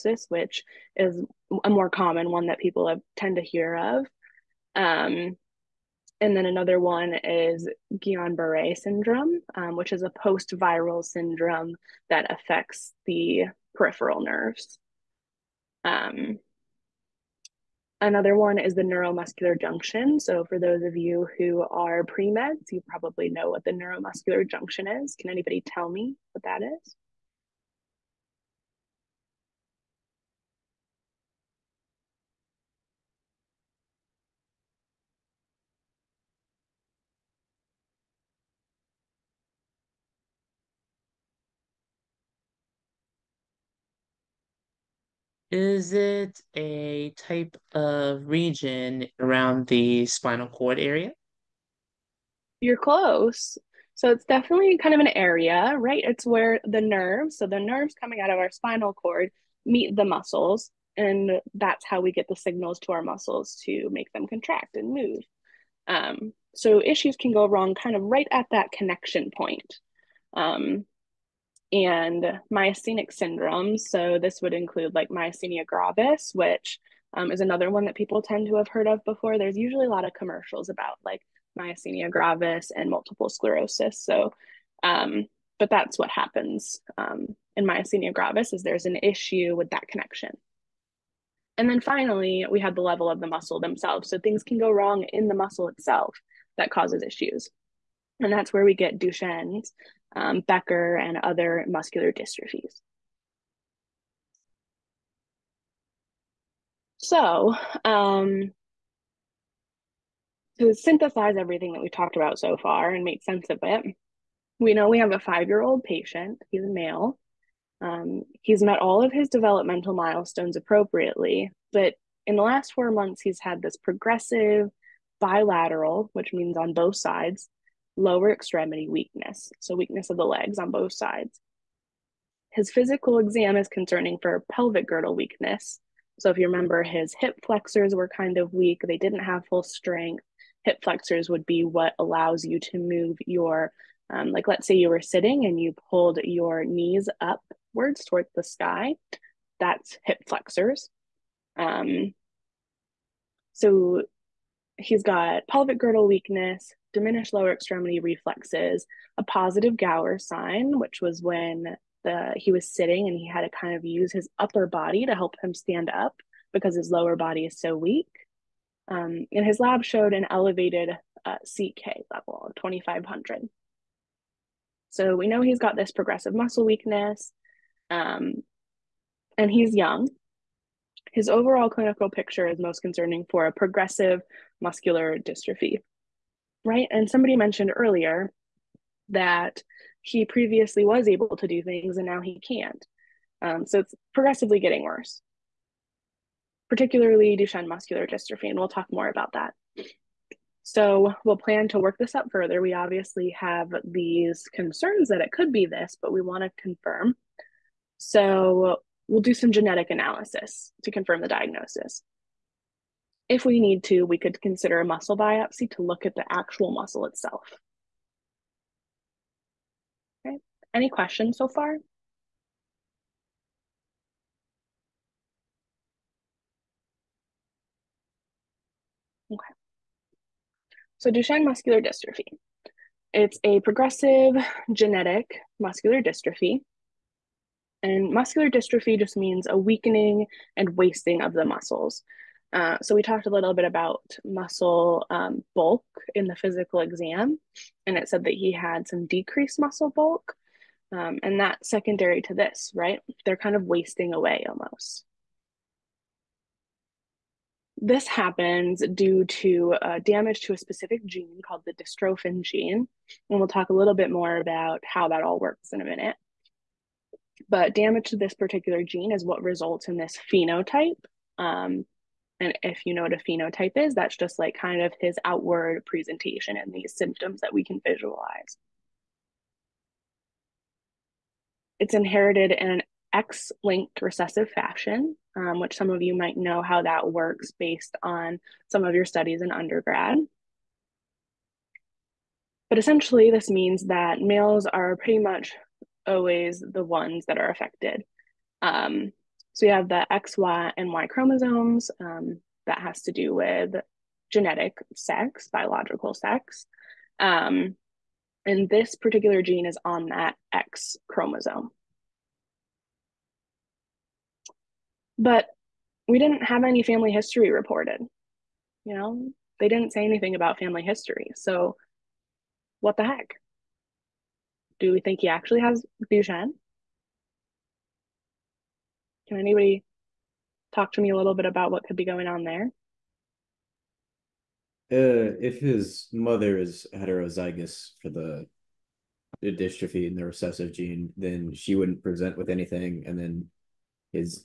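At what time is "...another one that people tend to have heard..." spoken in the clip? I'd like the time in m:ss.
1:17.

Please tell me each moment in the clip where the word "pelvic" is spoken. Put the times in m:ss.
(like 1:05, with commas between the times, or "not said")
2:14, 2:35.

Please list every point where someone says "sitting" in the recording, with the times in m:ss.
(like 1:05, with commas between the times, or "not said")
2:25, 2:42.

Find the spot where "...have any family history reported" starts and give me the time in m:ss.
5:16.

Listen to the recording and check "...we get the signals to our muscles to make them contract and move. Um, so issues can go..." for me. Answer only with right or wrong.
right.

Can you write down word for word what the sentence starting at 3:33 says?
If we need to, we could consider a muscle biopsy to look at the actual muscle itself.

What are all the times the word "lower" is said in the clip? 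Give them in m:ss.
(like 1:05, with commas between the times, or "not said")
2:07, 2:37, 2:46.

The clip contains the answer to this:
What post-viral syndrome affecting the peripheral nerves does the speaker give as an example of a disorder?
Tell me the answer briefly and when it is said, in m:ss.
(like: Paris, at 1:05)
Guillain Barre syndrome, at 0:07.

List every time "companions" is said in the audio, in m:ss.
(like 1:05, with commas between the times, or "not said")
not said.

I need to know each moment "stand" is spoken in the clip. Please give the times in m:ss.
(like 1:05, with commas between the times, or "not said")
2:45.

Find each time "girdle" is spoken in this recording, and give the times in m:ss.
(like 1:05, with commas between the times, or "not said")
2:14, 2:35.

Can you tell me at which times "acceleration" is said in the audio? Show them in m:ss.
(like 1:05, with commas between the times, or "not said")
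not said.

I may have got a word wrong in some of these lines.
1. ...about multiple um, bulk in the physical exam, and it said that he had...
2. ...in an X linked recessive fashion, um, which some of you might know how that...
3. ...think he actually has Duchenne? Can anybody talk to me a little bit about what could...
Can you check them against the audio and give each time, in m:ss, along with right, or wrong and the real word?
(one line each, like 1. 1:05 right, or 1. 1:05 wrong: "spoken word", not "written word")
1. 4:03 wrong: "muscle", not "multiple"
2. 4:42 right
3. 5:24 right.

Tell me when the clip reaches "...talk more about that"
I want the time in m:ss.
3:18.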